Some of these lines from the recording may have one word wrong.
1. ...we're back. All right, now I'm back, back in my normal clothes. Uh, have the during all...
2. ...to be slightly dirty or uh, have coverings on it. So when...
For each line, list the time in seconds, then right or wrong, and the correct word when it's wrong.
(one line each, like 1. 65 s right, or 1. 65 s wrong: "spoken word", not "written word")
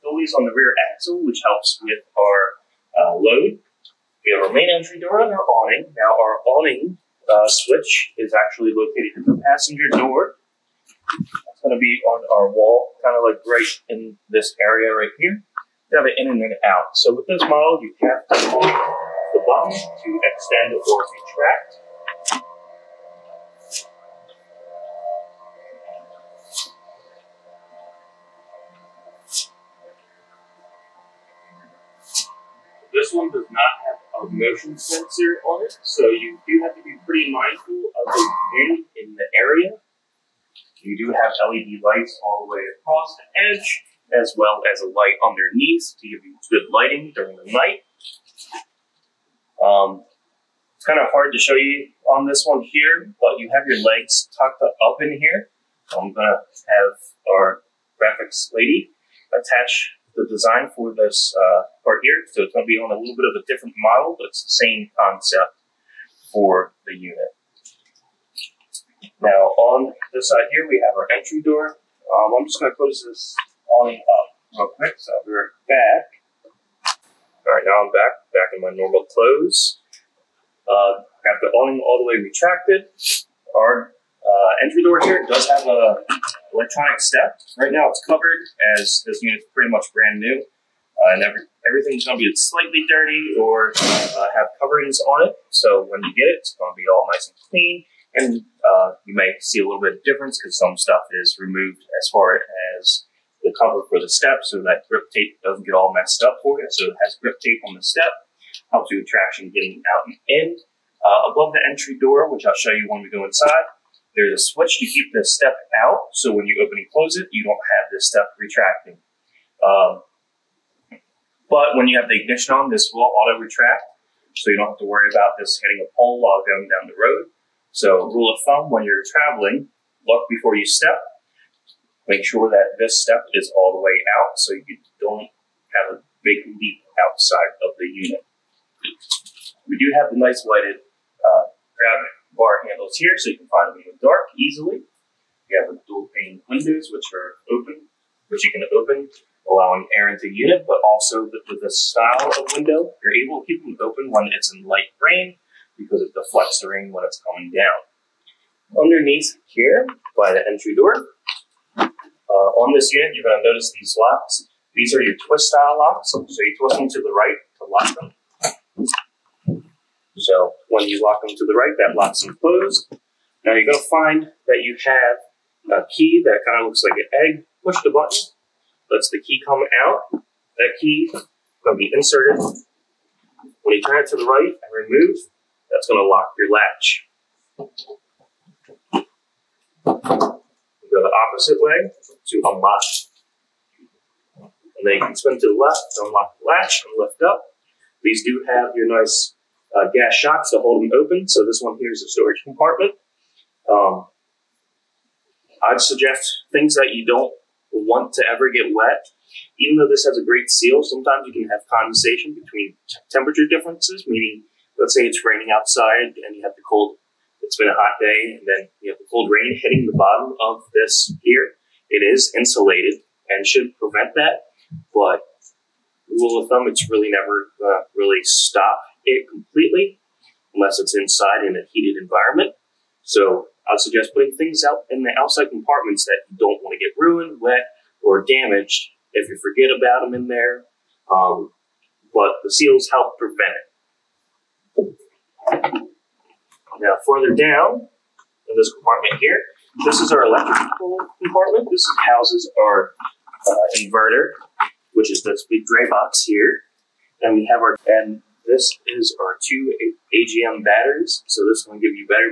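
1. 75 s wrong: "awning", not "during"
2. 92 s right.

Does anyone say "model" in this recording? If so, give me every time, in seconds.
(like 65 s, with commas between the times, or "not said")
17 s, 63 s.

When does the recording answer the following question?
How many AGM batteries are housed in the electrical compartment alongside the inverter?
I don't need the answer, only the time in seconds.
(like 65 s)
259 s.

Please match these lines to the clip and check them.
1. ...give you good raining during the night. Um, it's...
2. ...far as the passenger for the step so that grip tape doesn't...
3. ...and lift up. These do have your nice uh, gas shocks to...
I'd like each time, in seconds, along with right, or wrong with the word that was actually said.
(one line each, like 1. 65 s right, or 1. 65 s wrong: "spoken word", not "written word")
1. 46 s wrong: "lighting", not "raining"
2. 102 s wrong: "cover", not "passenger"
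3. 196 s right.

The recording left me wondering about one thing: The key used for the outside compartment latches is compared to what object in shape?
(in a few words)
An egg.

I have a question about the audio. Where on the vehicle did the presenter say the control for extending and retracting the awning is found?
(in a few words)
Passenger door.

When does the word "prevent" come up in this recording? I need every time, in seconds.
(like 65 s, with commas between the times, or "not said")
223 s, 243 s.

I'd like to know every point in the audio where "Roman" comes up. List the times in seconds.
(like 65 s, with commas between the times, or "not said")
not said.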